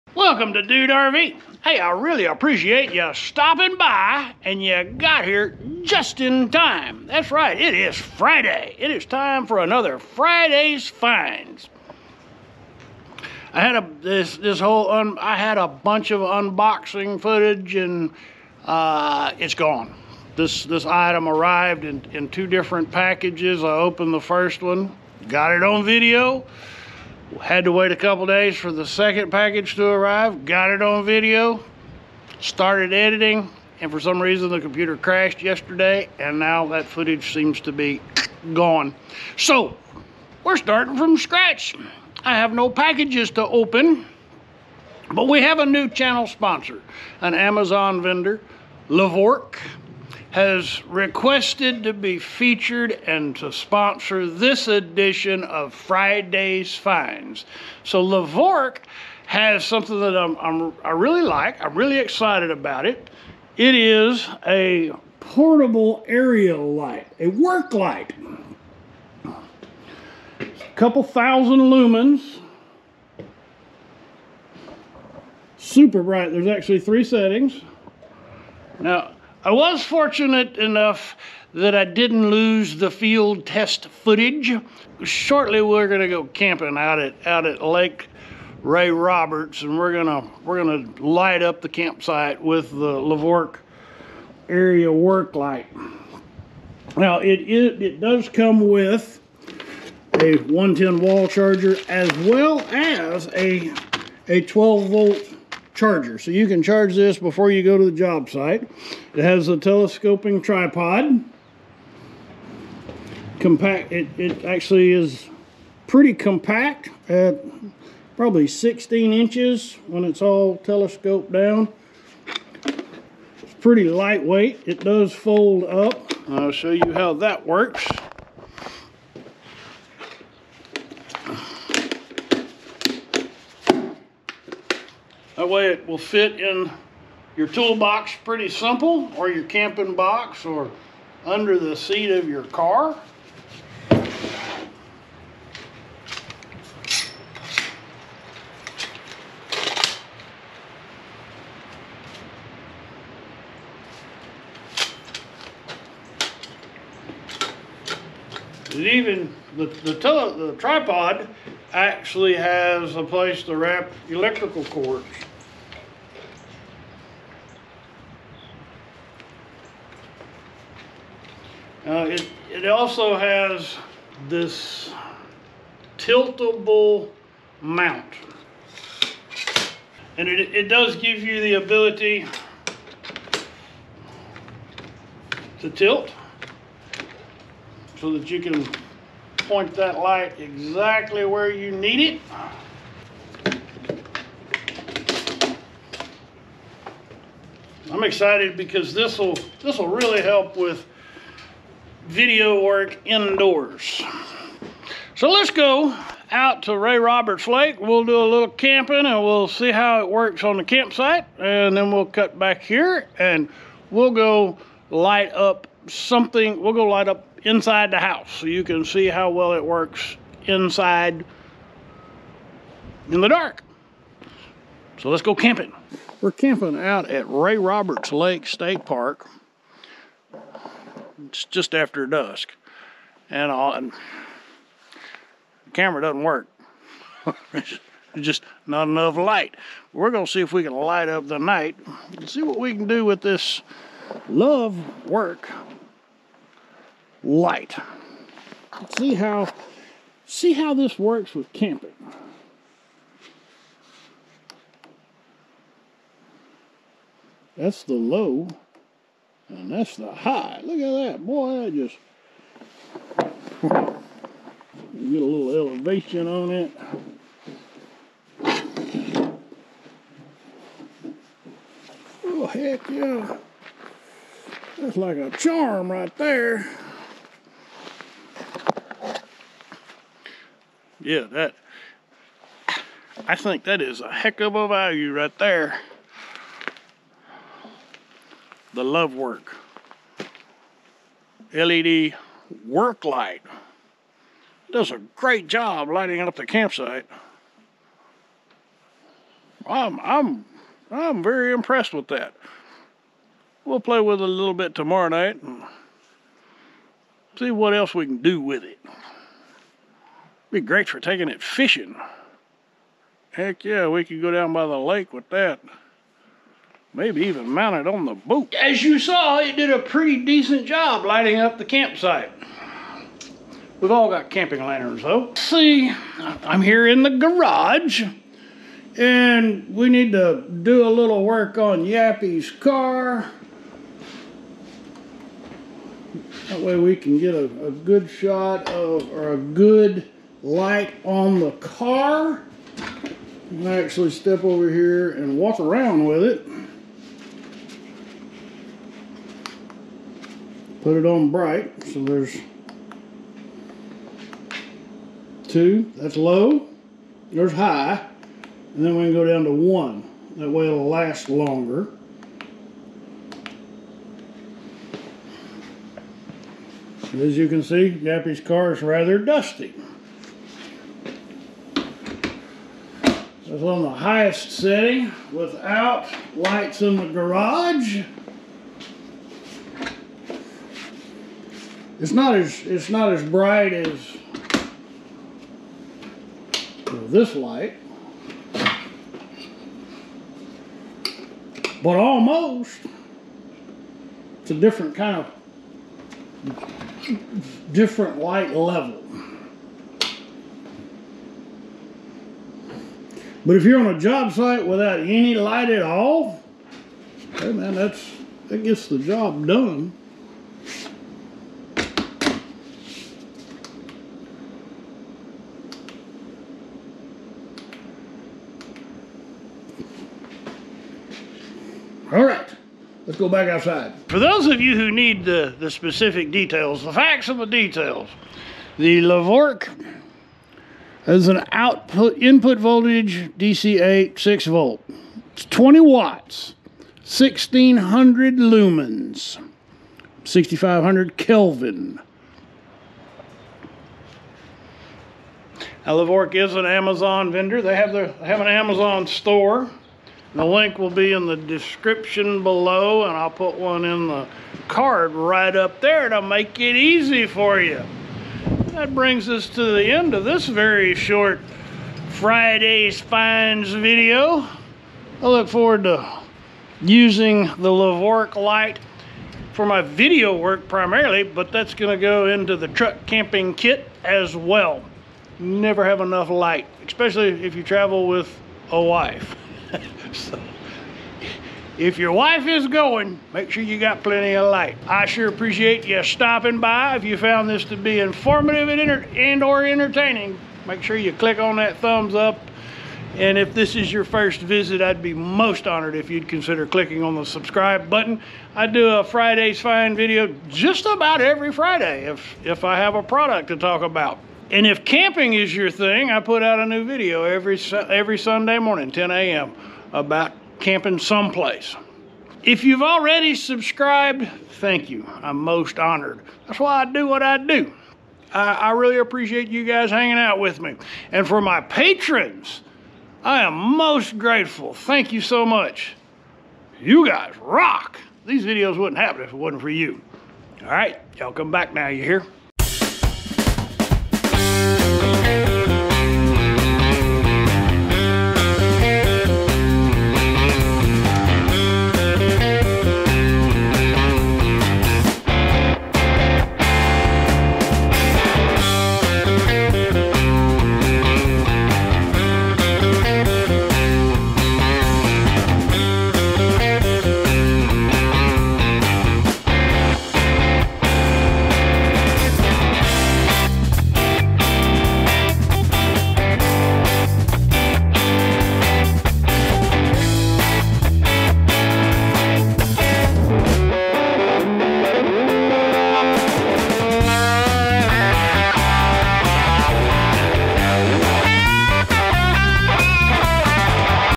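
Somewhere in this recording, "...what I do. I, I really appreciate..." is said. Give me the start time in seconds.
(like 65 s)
517 s.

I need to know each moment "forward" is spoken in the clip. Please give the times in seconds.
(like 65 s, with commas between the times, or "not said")
465 s.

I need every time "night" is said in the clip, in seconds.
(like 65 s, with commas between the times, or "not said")
241 s, 305 s.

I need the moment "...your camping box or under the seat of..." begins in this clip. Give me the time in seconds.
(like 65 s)
139 s.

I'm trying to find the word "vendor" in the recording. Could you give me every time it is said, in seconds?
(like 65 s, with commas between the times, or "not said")
48 s, 447 s.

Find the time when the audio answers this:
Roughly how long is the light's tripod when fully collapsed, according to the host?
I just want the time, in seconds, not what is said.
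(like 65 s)
118 s.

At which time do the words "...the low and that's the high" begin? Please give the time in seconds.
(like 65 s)
257 s.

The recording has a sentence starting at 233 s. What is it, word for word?
And, all, and the camera doesn't work.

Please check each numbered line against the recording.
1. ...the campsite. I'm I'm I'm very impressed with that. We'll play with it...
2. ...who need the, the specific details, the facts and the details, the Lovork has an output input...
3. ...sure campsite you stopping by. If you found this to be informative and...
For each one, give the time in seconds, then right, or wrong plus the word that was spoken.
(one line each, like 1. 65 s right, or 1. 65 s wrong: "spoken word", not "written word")
1. 296 s right
2. 424 s right
3. 485 s wrong: "appreciate", not "campsite".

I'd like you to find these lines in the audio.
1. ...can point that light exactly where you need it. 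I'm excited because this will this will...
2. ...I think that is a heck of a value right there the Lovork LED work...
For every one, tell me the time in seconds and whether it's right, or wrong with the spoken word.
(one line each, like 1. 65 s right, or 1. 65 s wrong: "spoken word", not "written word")
1. 188 s right
2. 283 s right.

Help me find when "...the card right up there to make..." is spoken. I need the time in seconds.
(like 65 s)
454 s.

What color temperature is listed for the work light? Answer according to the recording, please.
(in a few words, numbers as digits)
6500 Kelvin.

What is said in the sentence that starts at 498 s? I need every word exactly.
I do a Friday's Fine video just about every Friday if, if I have a product to talk about.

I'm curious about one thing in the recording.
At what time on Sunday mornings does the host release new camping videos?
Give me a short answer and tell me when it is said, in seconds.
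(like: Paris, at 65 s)
10 a.m., at 508 s.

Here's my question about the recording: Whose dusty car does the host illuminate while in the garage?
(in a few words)
Yappy's.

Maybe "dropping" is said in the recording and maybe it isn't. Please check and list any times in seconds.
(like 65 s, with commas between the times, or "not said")
not said.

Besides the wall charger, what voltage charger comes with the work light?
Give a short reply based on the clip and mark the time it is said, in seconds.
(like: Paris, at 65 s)
12 volt, at 104 s.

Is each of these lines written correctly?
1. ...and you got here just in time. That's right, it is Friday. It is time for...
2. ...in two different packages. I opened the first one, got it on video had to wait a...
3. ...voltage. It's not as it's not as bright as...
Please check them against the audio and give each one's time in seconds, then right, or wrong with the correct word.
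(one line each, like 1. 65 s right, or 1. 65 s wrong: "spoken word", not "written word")
1. 4 s right
2. 22 s right
3. 377 s wrong: "garage", not "voltage".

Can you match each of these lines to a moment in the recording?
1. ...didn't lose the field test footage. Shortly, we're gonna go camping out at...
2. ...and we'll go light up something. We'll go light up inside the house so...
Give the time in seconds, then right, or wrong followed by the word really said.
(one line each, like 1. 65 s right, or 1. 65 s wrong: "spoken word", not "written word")
1. 81 s right
2. 213 s right.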